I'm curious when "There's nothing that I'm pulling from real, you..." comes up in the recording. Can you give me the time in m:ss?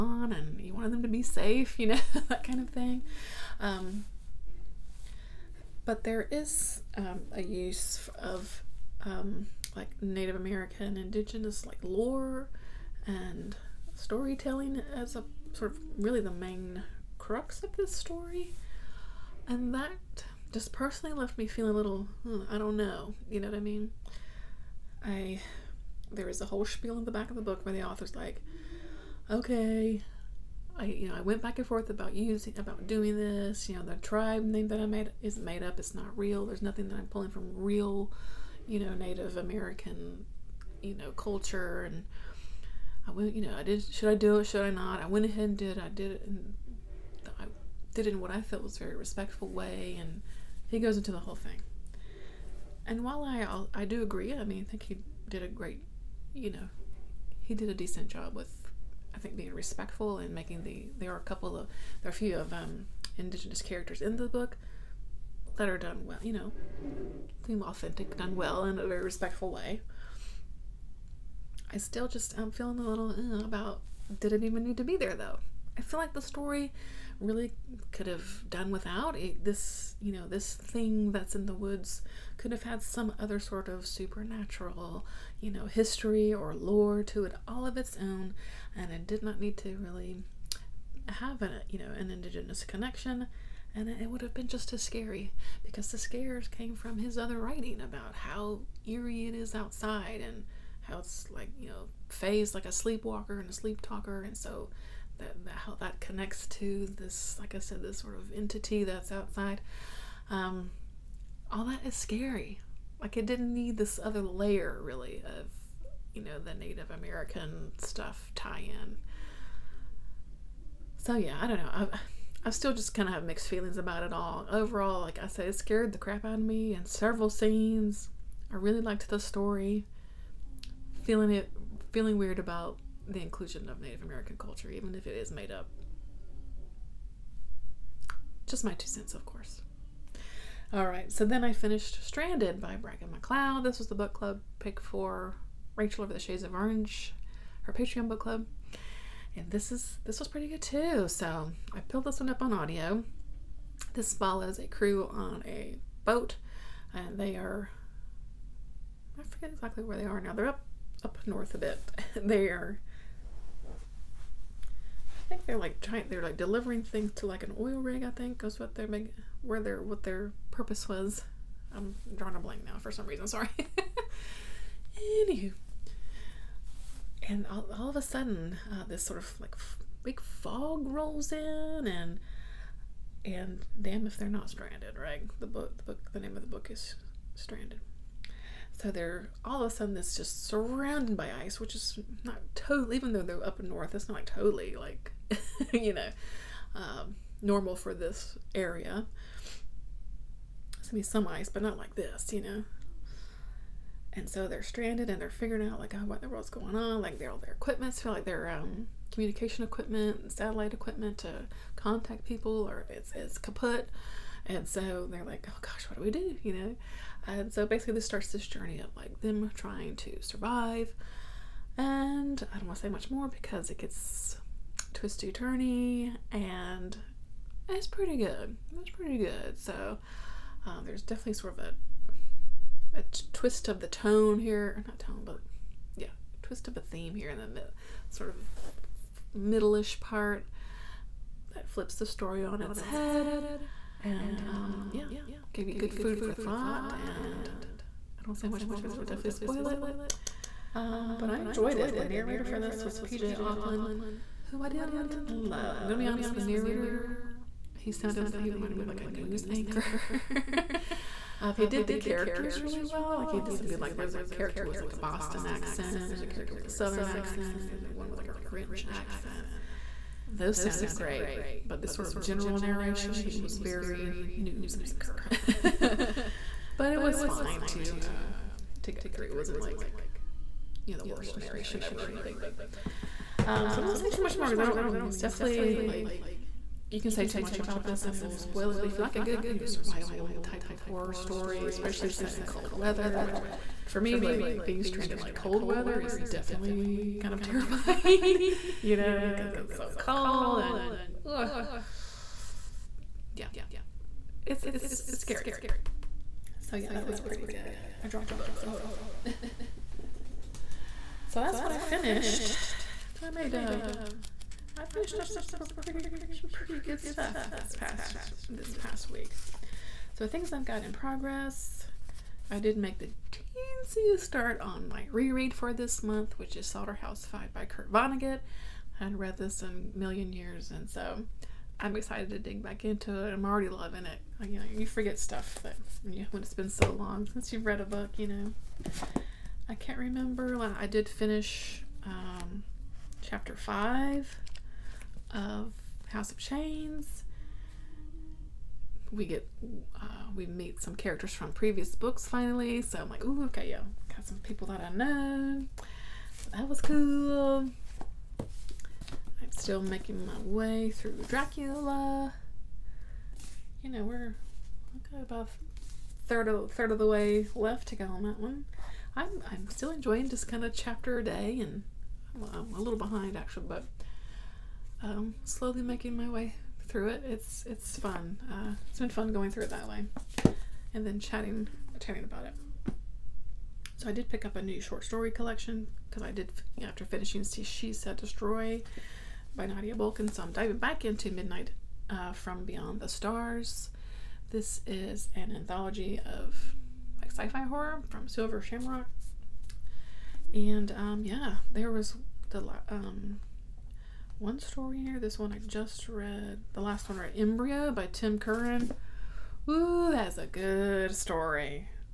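0:36.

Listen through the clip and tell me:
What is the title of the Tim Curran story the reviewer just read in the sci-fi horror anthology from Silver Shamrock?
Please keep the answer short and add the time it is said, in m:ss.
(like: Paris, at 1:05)
Embryo, at 6:47.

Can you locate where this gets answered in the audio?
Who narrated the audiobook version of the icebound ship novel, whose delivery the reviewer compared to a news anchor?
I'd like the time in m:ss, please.
4:12.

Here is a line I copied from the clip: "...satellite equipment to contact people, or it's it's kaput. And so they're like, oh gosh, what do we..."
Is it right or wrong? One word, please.
right.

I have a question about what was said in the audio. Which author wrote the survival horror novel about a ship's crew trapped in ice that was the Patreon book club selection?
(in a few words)
Bracken Macleod.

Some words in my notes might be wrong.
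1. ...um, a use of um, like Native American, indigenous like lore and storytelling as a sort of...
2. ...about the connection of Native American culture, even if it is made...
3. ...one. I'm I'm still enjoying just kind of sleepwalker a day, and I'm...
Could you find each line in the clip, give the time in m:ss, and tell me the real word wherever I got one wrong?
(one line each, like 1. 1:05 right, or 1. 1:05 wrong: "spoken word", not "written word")
1. 0:06 right
2. 2:12 wrong: "inclusion", not "connection"
3. 6:08 wrong: "chapter", not "sleepwalker".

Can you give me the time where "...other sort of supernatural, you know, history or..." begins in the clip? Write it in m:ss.
1:23.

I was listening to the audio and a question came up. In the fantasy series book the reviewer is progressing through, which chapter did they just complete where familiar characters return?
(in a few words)
5.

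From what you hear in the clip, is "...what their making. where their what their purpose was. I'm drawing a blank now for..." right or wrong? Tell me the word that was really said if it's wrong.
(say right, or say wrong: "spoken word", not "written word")
right.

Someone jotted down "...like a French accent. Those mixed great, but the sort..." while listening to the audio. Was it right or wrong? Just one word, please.
wrong.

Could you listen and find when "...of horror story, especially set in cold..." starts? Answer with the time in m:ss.
4:50.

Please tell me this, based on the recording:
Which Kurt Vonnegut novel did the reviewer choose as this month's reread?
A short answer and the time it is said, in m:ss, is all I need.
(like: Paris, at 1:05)
Slaughterhouse 5, at 5:26.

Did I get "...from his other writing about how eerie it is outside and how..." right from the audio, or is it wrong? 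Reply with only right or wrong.
right.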